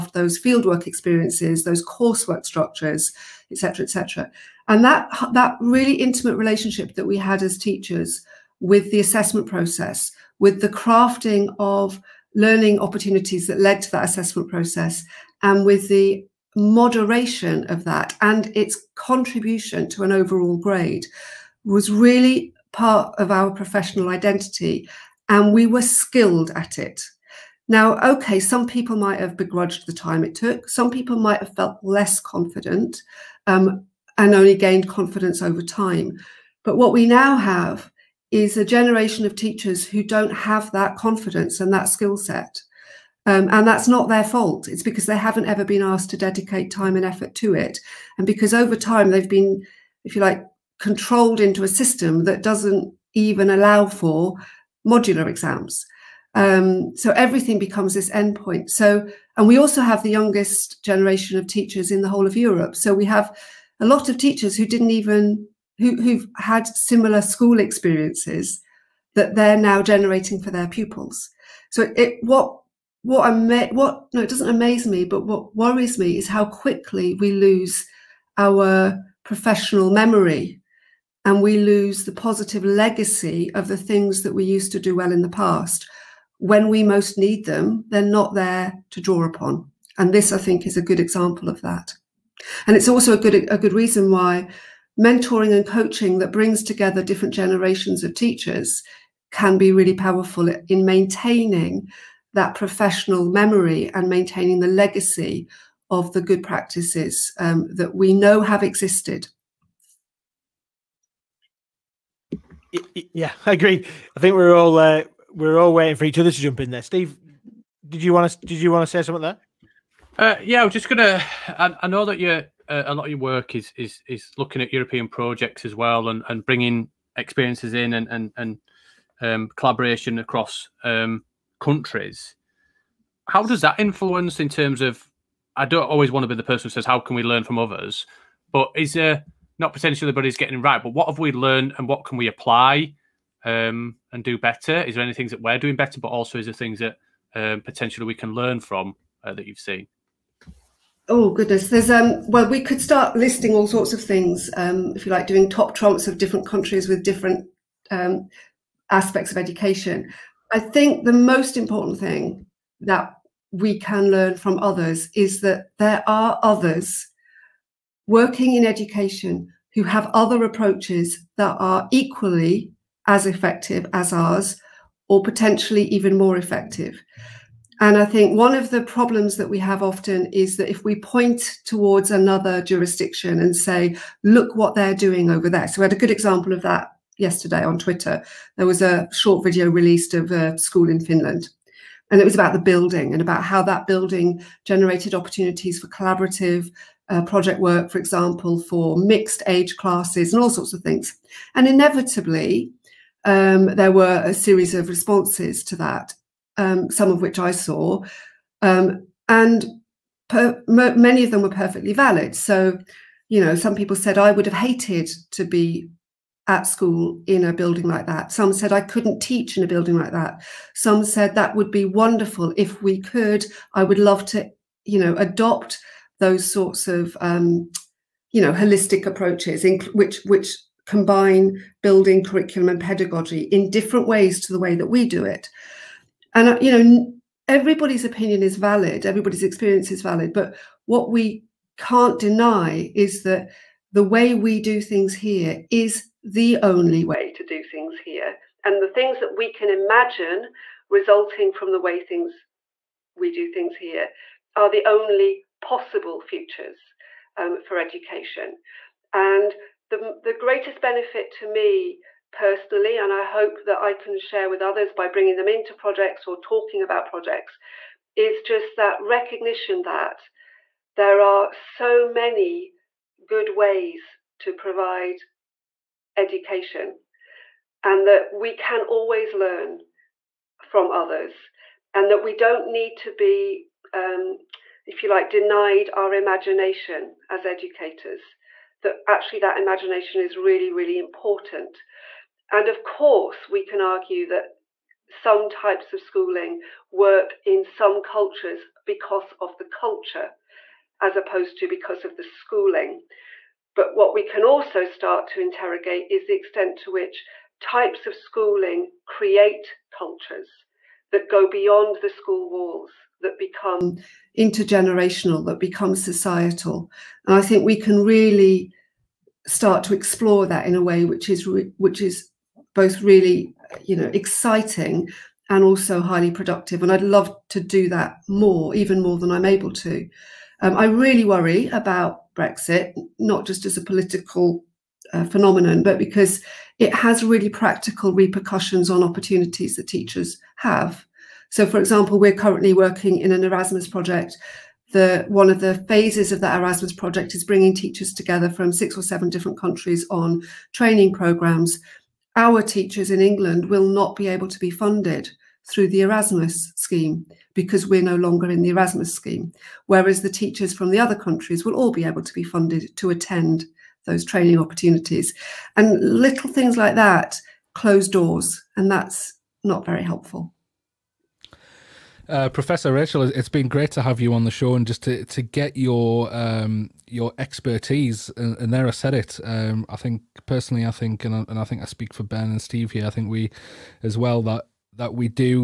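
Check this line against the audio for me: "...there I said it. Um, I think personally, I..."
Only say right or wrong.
right.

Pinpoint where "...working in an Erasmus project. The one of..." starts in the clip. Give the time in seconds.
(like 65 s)
342 s.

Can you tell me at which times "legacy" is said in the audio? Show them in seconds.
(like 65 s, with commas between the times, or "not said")
82 s, 104 s.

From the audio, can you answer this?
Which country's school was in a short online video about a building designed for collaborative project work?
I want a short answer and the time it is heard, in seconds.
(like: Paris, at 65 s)
Finland, at 191 s.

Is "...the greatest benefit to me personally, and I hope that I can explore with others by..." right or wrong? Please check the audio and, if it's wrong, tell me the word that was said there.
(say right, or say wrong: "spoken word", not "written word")
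wrong: "share", not "explore".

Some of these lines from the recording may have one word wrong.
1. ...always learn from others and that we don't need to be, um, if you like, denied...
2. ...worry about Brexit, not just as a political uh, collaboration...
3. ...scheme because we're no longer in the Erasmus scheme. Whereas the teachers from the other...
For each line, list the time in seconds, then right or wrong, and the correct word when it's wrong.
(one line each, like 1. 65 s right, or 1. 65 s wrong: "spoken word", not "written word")
1. 278 s right
2. 331 s wrong: "phenomenon", not "collaboration"
3. 356 s right.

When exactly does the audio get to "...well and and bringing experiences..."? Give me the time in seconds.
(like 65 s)
125 s.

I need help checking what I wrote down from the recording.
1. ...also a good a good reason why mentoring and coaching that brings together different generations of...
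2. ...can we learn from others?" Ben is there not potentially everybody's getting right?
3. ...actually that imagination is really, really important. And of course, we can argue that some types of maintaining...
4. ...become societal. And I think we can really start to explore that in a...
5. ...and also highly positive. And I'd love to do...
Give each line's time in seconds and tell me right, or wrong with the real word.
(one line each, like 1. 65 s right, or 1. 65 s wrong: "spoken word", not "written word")
1. 92 s right
2. 136 s wrong: "But", not "Ben"
3. 289 s wrong: "schooling", not "maintaining"
4. 315 s right
5. 325 s wrong: "productive", not "positive".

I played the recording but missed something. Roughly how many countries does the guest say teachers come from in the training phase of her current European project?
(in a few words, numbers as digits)
6 or 7.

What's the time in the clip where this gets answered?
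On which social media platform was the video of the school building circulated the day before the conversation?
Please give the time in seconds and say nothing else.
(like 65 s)
187 s.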